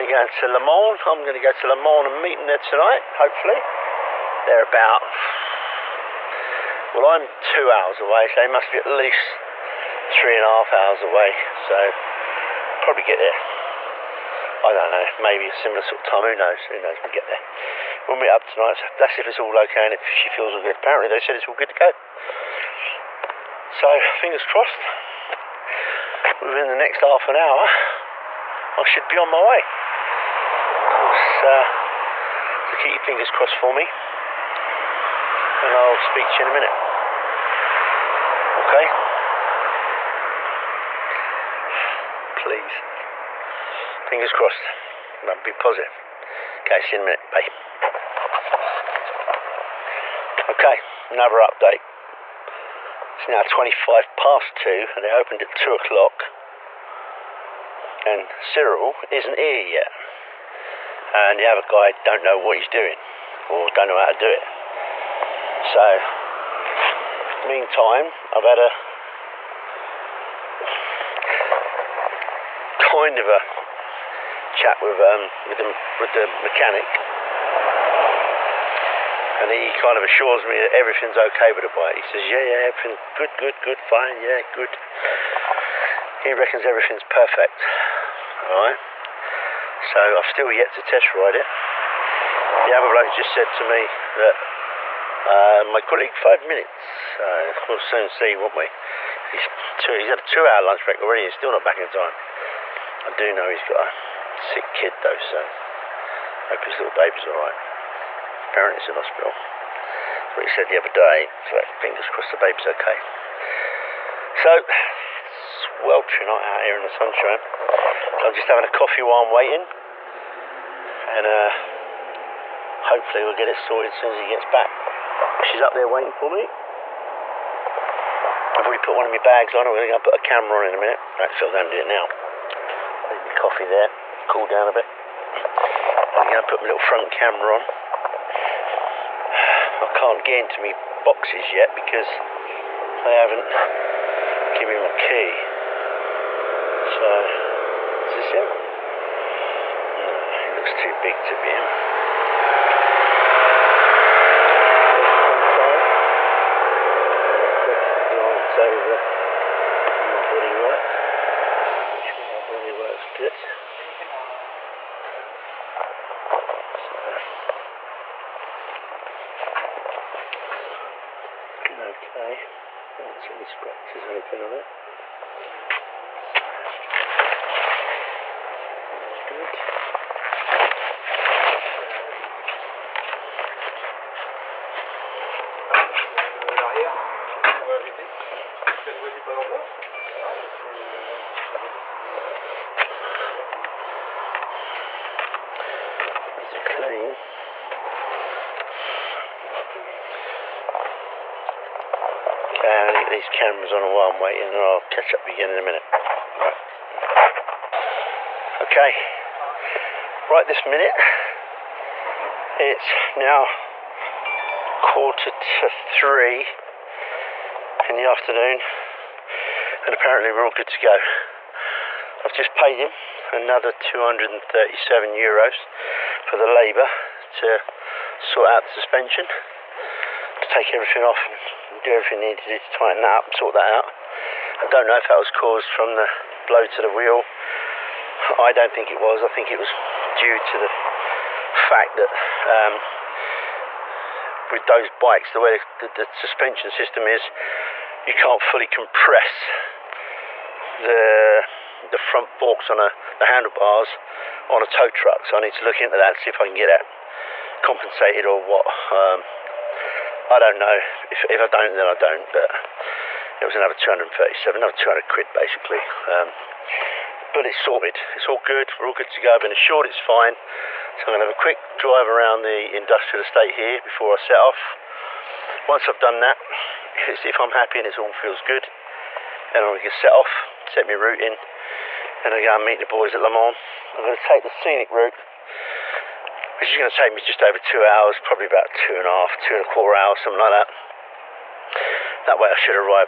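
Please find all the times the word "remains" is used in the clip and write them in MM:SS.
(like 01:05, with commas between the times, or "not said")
not said.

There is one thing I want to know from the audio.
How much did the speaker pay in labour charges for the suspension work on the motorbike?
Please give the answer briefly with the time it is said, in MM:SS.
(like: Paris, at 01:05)
237 euros, at 03:43.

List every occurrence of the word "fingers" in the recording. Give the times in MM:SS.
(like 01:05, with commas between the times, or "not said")
00:24, 00:33, 00:44, 01:51.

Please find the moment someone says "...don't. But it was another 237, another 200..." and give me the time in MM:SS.
04:21.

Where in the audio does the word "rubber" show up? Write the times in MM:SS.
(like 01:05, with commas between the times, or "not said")
not said.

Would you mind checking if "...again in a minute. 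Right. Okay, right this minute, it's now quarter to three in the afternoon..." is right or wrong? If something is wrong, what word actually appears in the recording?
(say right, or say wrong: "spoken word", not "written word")
right.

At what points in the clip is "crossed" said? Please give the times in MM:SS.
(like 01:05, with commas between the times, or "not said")
00:24, 00:33, 00:44, 01:52.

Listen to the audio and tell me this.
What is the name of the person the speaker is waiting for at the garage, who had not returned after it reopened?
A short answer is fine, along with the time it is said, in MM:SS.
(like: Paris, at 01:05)
Cyril, at 00:58.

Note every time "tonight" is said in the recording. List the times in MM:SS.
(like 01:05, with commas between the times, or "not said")
00:02, 00:18.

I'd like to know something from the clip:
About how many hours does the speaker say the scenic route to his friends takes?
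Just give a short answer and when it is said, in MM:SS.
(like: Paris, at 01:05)
just over 2 hours, at 04:47.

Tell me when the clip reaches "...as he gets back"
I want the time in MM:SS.
02:04.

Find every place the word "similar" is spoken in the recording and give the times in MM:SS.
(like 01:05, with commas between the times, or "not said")
00:15.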